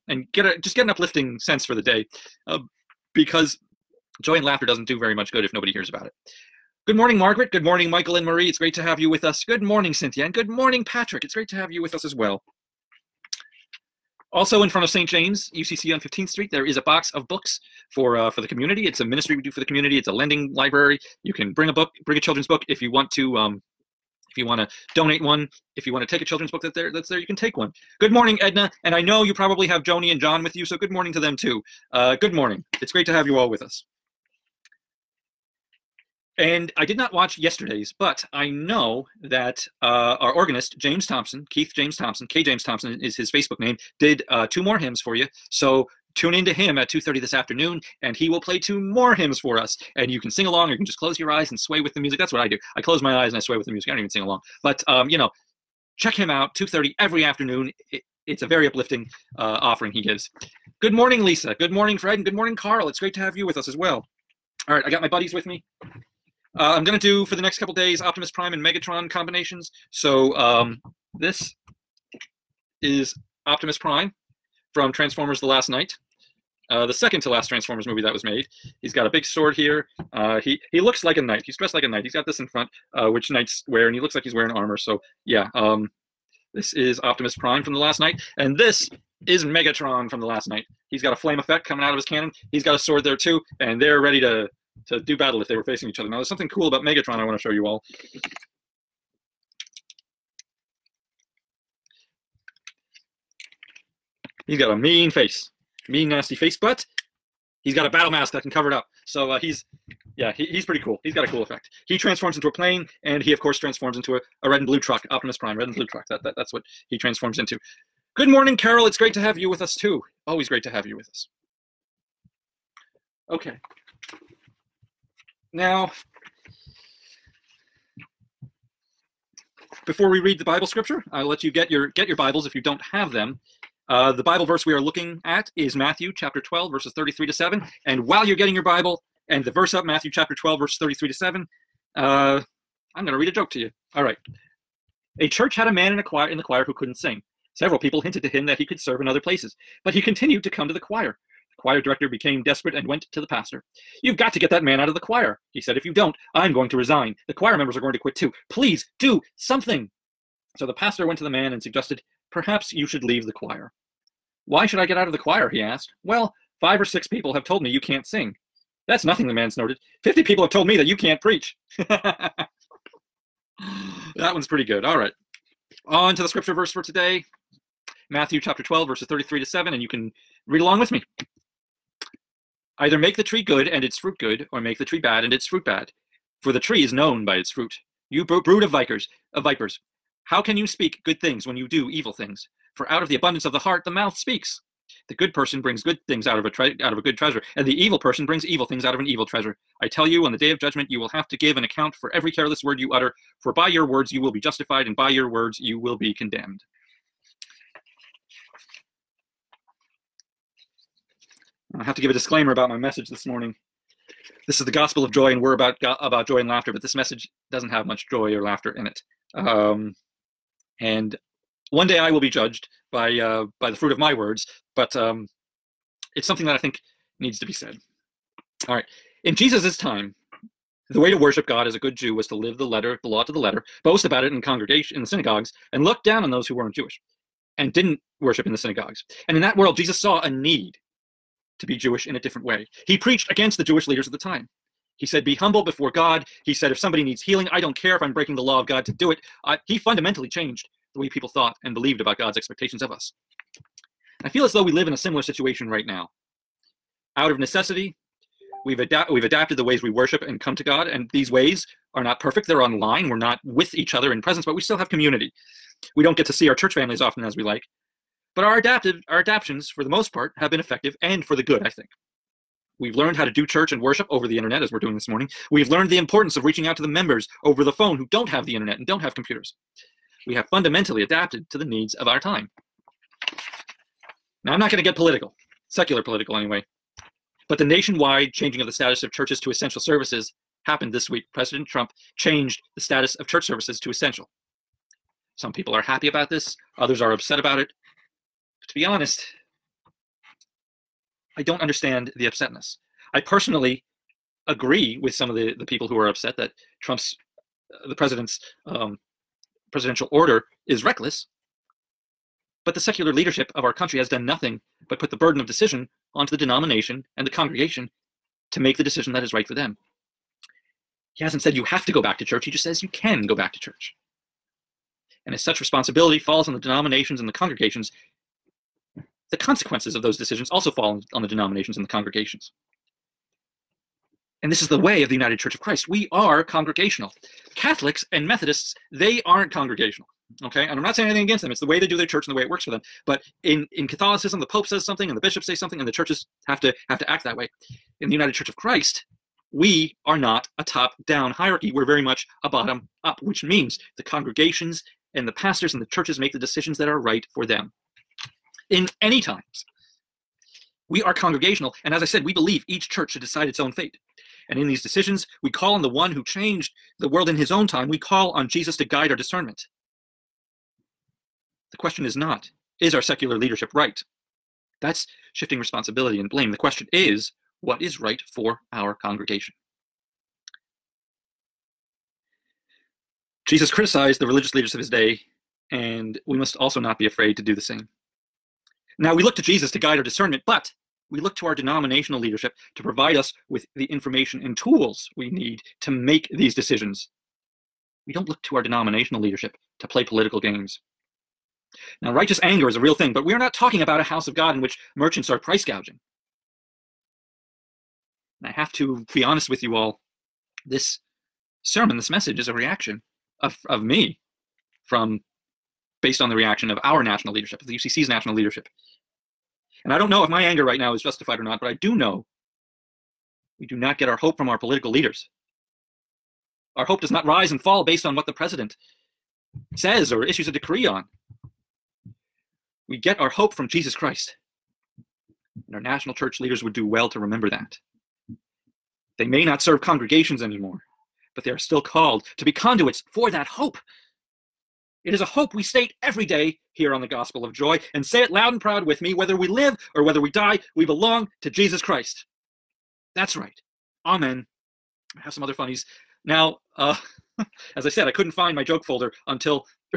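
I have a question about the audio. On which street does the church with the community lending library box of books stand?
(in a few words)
15th Street.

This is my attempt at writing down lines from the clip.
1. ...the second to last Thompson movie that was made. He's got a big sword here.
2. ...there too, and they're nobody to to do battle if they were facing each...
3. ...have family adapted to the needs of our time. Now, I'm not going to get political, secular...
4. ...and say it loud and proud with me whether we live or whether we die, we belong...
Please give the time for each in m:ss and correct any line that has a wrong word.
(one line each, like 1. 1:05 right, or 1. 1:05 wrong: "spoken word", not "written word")
1. 1:16 wrong: "Transformers", not "Thompson"
2. 1:33 wrong: "ready", not "nobody"
3. 4:40 wrong: "fundamentally", not "family"
4. 7:27 right.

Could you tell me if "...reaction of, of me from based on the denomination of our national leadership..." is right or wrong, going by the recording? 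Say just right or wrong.
wrong.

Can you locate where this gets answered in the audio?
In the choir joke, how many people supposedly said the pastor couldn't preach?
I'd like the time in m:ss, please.
2:50.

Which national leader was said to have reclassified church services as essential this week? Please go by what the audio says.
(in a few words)
President Trump.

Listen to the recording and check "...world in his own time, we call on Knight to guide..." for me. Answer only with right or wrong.
wrong.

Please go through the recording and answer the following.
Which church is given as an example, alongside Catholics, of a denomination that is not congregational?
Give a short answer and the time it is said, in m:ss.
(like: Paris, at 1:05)
Methodists, at 5:38.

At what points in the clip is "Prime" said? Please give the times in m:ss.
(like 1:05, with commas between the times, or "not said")
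1:08, 1:13, 1:27, 1:55.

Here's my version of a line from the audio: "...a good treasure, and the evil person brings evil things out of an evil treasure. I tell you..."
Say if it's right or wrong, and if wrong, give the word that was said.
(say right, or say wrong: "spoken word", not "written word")
right.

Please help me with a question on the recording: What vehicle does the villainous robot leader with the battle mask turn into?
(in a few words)
a plane.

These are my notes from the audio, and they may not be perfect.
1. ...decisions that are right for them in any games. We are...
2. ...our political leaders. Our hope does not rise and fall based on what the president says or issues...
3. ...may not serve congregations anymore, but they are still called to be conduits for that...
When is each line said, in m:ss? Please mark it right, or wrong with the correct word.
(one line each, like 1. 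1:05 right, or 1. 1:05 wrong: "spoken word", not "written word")
1. 5:56 wrong: "times", not "games"
2. 7:04 right
3. 7:19 right.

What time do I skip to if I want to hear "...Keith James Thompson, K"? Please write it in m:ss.
0:41.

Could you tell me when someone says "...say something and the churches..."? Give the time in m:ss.
5:45.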